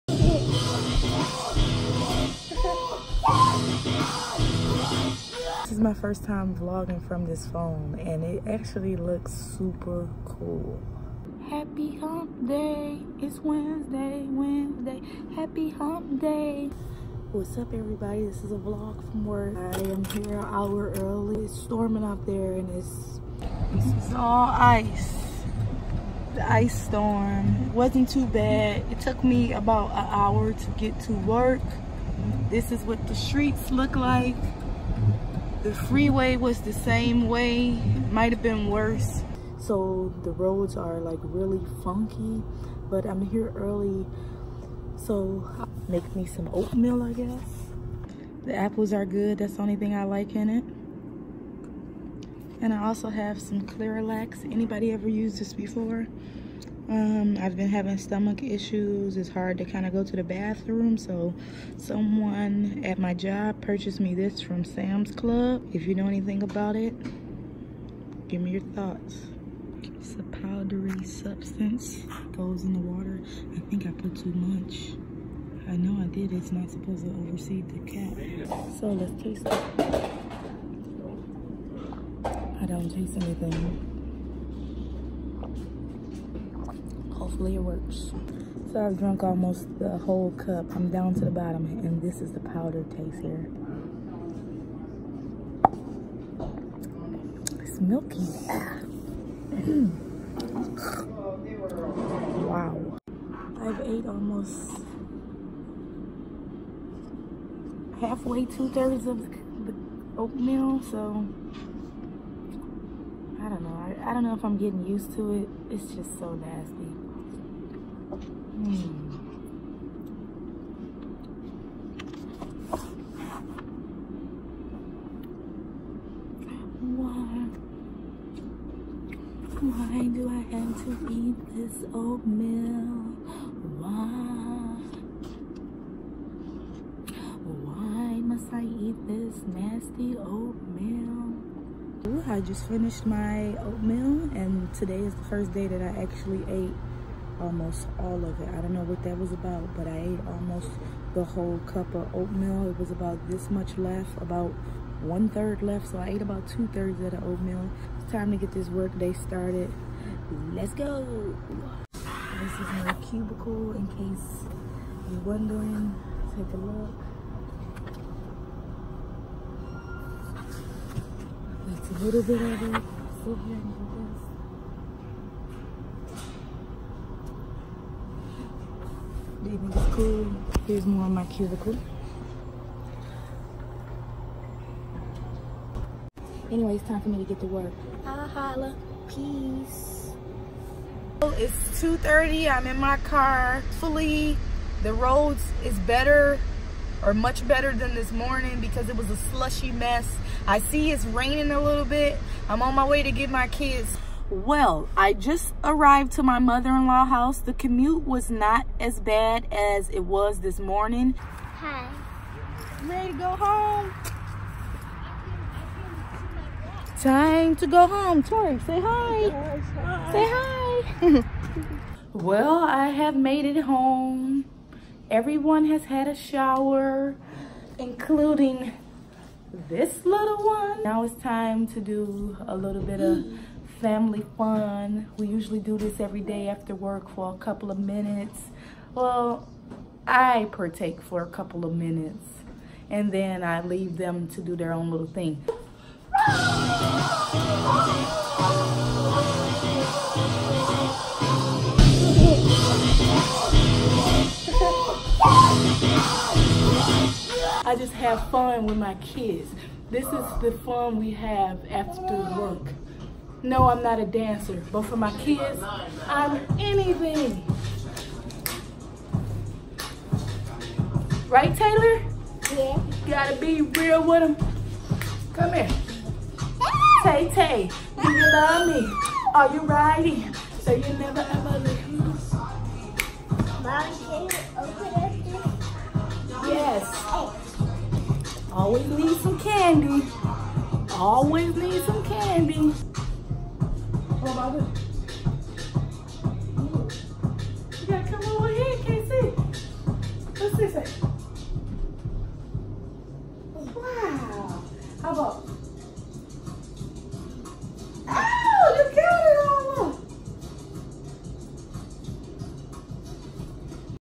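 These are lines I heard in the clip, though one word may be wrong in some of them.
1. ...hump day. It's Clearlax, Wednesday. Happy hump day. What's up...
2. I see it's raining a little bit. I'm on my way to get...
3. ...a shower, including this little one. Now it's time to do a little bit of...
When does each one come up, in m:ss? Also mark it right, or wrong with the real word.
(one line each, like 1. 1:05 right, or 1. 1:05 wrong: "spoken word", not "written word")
1. 0:11 wrong: "Wednesday", not "Clearlax"
2. 3:20 right
3. 3:46 right.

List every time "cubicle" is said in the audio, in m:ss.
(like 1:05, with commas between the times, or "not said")
2:43, 3:01.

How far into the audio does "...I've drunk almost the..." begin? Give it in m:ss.
1:28.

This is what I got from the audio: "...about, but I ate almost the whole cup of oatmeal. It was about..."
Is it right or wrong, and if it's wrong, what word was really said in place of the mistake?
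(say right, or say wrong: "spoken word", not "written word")
right.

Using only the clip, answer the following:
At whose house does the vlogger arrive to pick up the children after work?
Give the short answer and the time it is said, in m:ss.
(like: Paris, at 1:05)
Mother-in-law's house, at 3:26.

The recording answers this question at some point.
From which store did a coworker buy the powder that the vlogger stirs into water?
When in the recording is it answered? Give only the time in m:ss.
1:04.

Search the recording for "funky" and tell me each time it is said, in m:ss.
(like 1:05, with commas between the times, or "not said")
0:41.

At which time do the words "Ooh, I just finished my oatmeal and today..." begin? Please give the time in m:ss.
2:22.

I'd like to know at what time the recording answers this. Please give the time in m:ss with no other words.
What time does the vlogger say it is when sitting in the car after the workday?
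3:11.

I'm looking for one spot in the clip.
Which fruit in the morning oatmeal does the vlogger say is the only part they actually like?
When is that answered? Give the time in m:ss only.
0:48.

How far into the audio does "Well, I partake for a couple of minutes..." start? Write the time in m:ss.
3:58.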